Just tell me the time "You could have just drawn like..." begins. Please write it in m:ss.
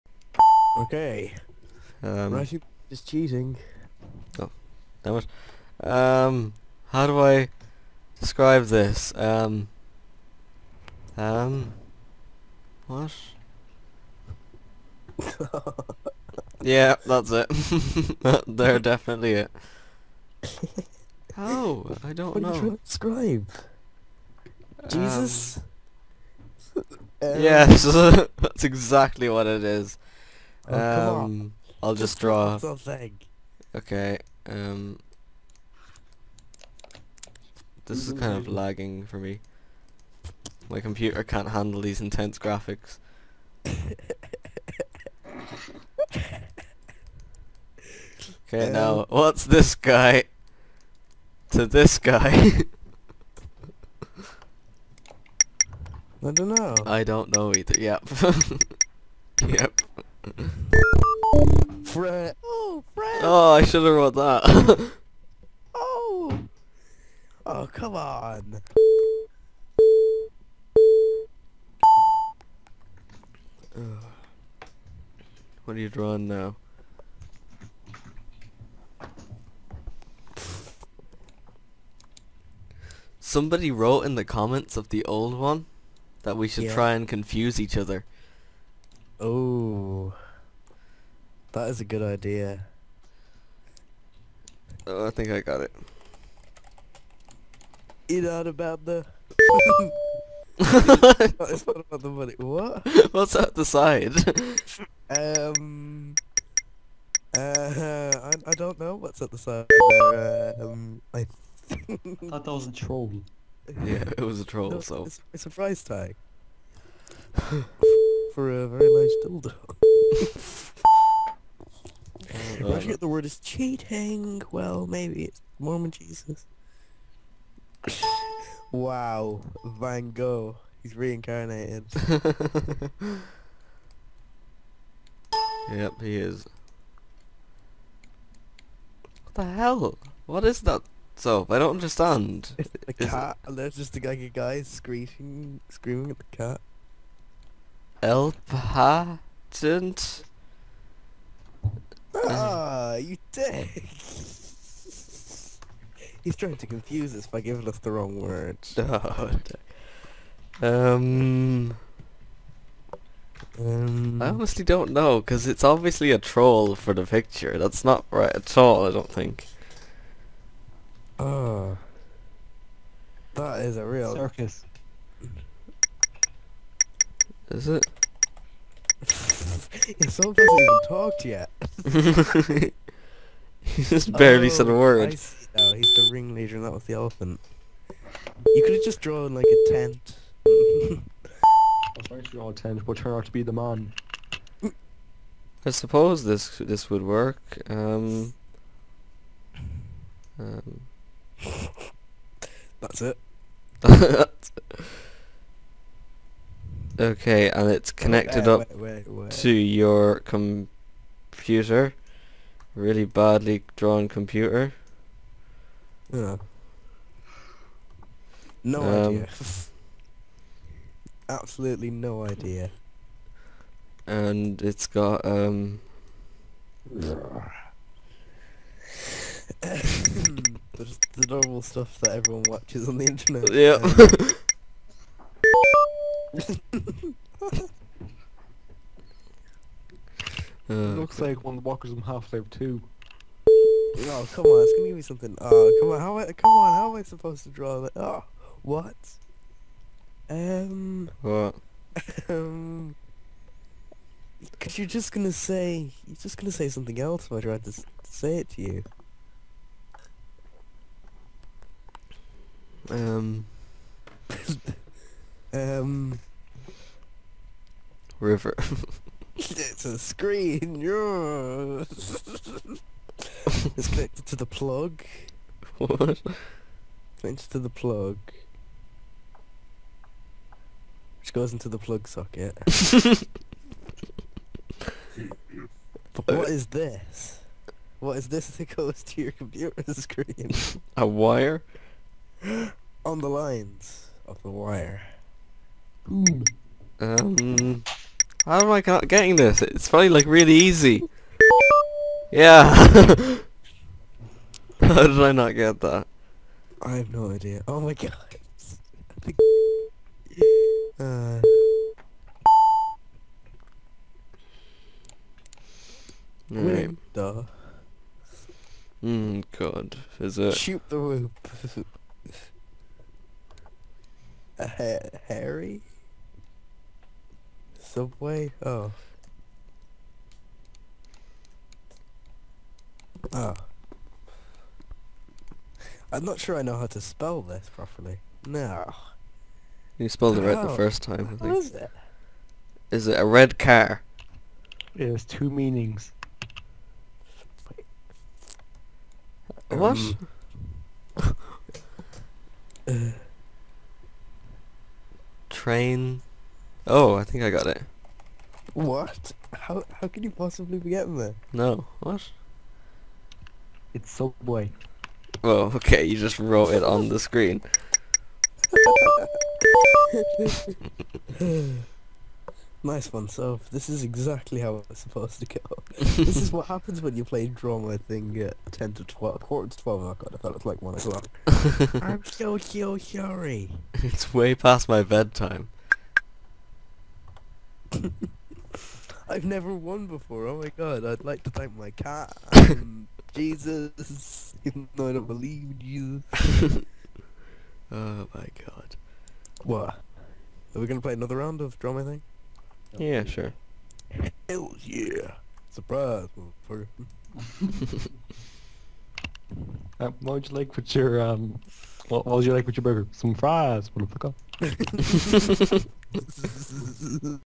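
3:08.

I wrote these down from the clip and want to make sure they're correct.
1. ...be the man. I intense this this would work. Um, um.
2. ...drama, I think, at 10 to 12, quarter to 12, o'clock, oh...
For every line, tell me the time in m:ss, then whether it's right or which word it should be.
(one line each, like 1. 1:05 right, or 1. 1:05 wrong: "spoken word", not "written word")
1. 3:13 wrong: "suppose", not "intense"
2. 6:17 right.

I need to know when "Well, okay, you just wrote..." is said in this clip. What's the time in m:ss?
6:05.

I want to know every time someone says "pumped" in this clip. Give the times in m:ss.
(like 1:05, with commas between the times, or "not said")
not said.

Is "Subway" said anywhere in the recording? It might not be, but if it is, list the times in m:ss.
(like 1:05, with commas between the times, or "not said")
5:27, 6:04.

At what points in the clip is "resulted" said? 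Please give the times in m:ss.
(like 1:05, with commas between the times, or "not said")
not said.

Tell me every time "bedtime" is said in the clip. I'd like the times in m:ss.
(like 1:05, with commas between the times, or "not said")
6:25.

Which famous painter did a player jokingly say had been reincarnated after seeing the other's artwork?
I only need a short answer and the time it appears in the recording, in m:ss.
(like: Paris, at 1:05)
Van Gogh, at 2:09.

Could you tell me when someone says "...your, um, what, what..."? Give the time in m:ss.
6:50.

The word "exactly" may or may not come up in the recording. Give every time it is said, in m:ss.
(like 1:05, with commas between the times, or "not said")
0:28, 6:14.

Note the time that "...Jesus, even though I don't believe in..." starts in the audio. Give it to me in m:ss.
6:33.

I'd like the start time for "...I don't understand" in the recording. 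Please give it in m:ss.
2:21.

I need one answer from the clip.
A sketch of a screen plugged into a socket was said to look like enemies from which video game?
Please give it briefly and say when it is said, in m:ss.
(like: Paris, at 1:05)
Half-Life 2, at 4:02.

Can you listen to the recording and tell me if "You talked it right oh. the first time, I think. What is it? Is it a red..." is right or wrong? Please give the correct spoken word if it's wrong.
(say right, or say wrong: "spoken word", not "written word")
wrong: "spelled", not "talked".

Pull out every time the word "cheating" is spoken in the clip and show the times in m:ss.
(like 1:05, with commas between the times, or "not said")
0:03, 2:03.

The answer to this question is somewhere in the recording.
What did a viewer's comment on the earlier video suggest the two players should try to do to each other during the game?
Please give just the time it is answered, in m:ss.
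1:27.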